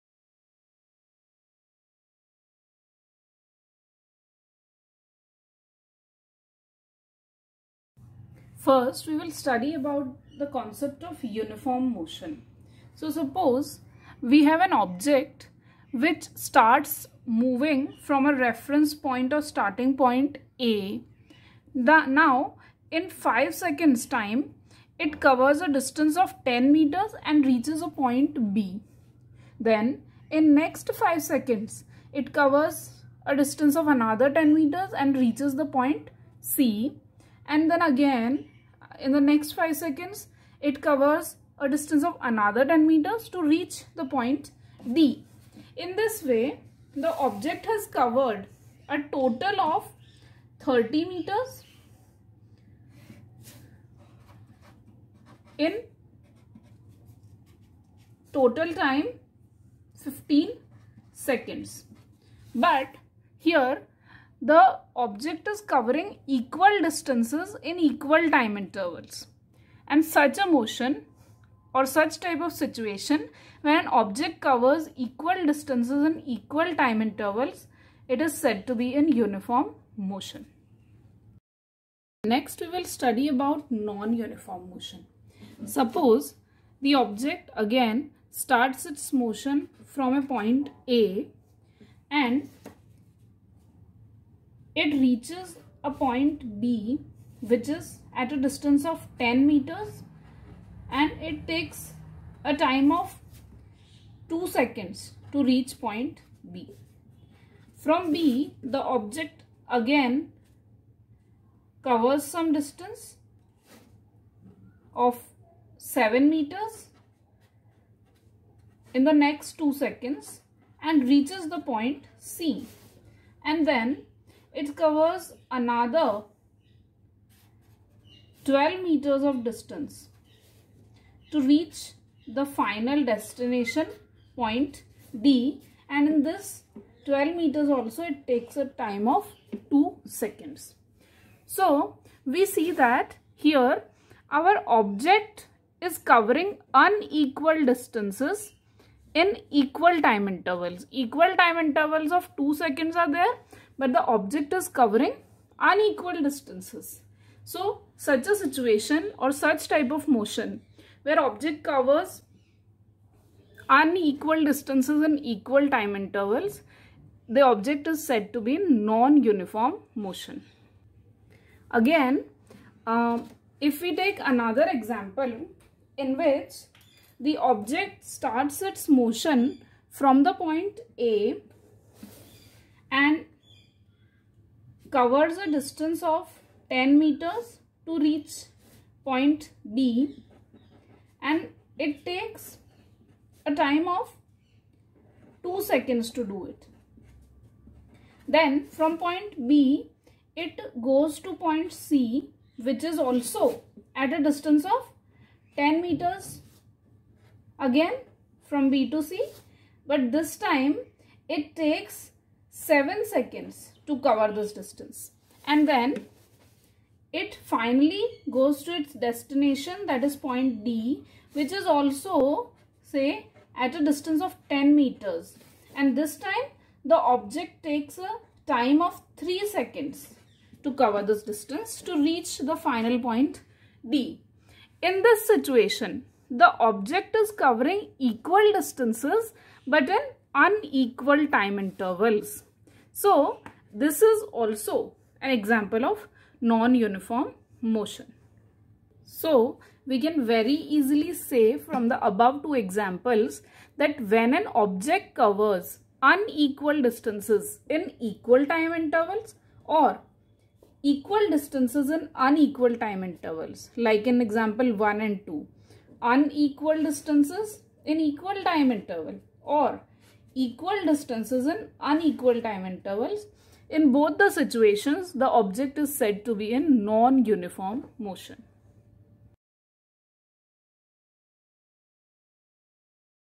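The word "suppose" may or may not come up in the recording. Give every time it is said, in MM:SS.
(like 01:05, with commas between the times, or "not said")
00:13, 01:25.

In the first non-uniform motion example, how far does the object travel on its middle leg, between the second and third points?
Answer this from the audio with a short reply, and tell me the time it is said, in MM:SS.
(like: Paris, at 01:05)
7 meters, at 01:55.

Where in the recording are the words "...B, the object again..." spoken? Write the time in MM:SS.
01:48.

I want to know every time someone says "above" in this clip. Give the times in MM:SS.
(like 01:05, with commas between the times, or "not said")
04:12.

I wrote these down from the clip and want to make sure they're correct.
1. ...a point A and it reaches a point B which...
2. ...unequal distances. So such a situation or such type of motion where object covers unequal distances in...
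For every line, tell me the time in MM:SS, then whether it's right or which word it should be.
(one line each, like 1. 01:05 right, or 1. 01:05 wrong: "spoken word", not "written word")
1. 01:30 right
2. 02:35 right.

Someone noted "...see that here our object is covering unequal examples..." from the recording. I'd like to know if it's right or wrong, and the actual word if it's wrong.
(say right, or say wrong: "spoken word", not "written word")
wrong: "distances", not "examples".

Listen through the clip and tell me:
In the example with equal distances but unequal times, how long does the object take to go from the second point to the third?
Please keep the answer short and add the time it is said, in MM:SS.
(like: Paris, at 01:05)
7 seconds, at 03:32.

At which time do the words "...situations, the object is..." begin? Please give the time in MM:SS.
04:34.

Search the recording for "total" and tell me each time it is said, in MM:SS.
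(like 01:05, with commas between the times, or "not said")
00:49, 00:58.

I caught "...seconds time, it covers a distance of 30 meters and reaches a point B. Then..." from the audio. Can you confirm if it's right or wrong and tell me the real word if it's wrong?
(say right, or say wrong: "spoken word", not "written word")
wrong: "10", not "30".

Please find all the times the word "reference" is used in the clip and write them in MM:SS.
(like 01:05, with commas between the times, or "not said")
00:18.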